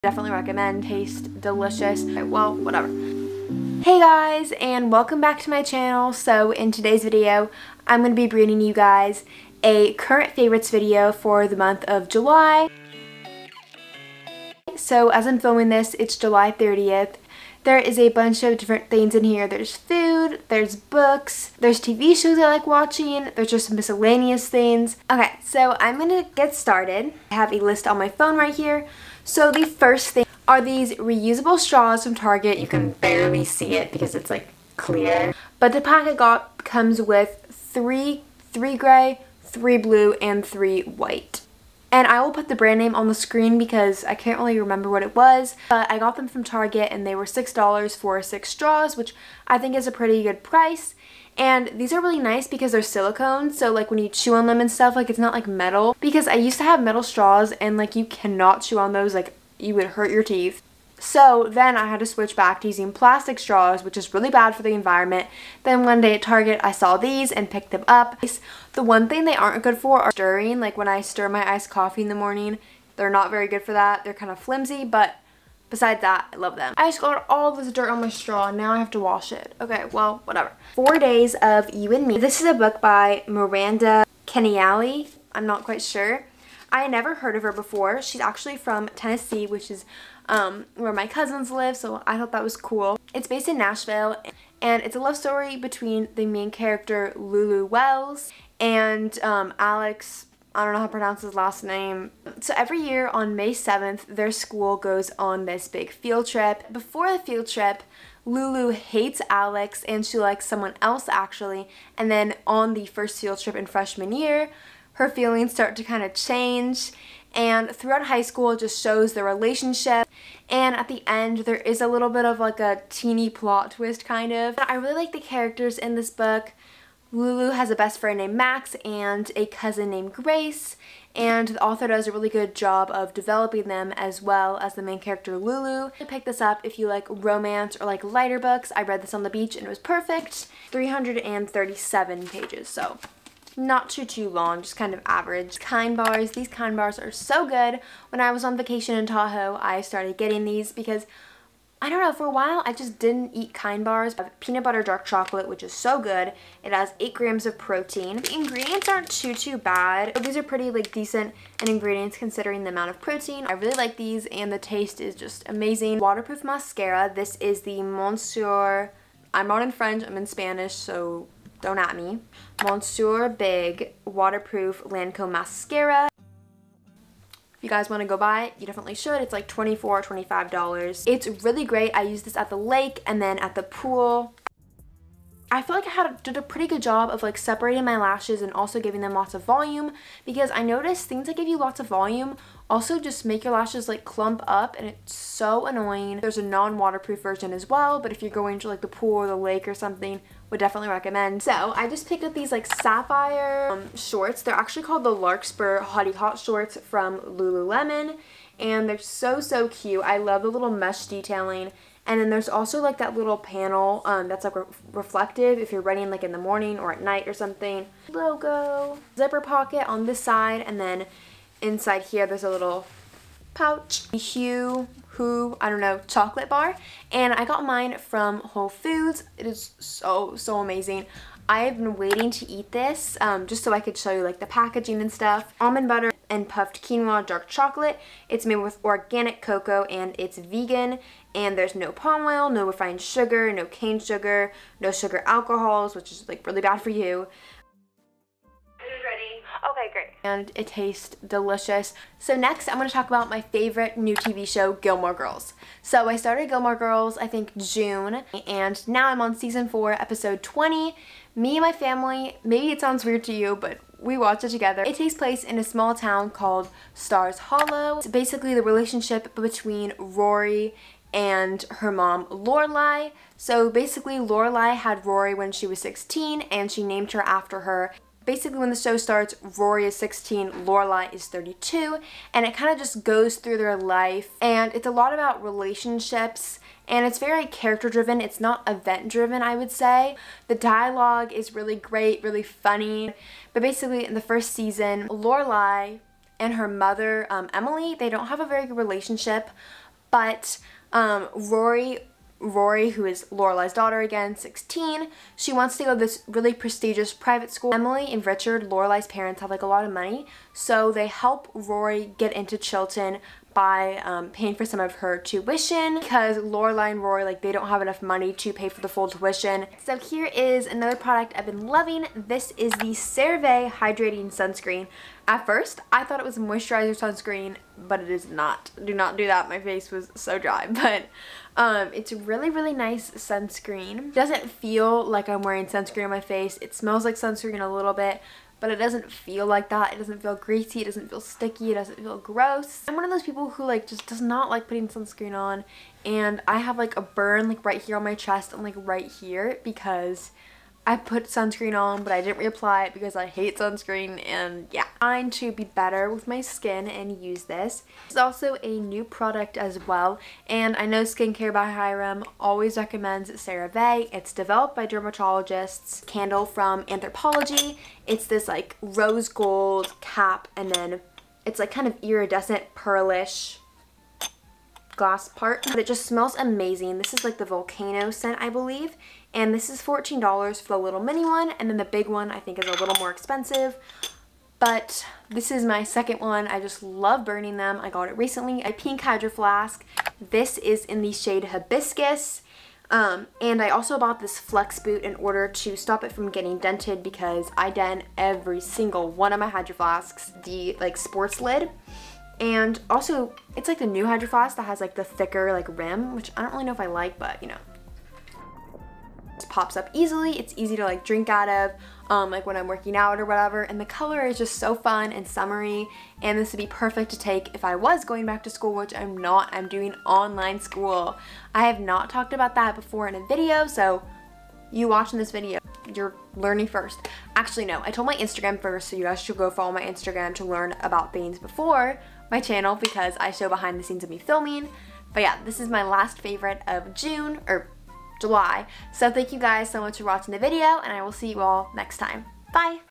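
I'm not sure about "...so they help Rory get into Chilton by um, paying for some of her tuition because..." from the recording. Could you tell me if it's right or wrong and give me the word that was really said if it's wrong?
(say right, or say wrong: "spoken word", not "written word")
right.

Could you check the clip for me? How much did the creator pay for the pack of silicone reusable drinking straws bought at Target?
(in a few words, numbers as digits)
$6.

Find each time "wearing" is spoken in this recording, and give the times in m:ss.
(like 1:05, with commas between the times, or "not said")
5:35.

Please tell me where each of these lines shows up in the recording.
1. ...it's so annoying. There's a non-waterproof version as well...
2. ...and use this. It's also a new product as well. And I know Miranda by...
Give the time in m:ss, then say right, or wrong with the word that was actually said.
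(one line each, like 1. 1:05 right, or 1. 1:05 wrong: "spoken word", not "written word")
1. 3:14 right
2. 5:56 wrong: "Skincare", not "Miranda".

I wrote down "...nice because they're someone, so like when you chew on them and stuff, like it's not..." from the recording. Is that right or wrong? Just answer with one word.
wrong.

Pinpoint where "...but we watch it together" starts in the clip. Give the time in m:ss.
4:23.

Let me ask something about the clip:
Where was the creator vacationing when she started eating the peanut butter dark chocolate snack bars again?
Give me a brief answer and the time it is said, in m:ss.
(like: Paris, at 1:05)
Tahoe, at 2:29.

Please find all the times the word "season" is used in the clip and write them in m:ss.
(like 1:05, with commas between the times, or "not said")
4:19, 4:54.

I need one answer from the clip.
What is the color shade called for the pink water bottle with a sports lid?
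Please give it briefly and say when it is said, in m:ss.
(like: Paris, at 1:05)
Hibiscus, at 6:31.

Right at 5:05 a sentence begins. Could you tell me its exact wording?
She wants to go to this really prestigious private school.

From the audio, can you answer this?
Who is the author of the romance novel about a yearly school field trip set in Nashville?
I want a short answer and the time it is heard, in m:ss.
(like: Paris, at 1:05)
Miranda Kenneally, at 1:23.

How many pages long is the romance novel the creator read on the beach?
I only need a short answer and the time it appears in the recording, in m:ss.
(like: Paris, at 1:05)
337, at 2:20.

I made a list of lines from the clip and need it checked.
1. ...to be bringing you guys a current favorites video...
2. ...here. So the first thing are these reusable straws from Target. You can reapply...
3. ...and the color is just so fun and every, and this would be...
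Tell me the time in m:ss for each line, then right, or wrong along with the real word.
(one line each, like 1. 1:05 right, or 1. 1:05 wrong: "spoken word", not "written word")
1. 0:08 right
2. 0:28 wrong: "barely", not "reapply"
3. 6:53 wrong: "summery", not "every".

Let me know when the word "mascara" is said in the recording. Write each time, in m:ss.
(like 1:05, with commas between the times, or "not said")
2:46, 2:55.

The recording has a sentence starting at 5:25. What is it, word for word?
At first, I thought it was a moisturizer sunscreen, but it is not.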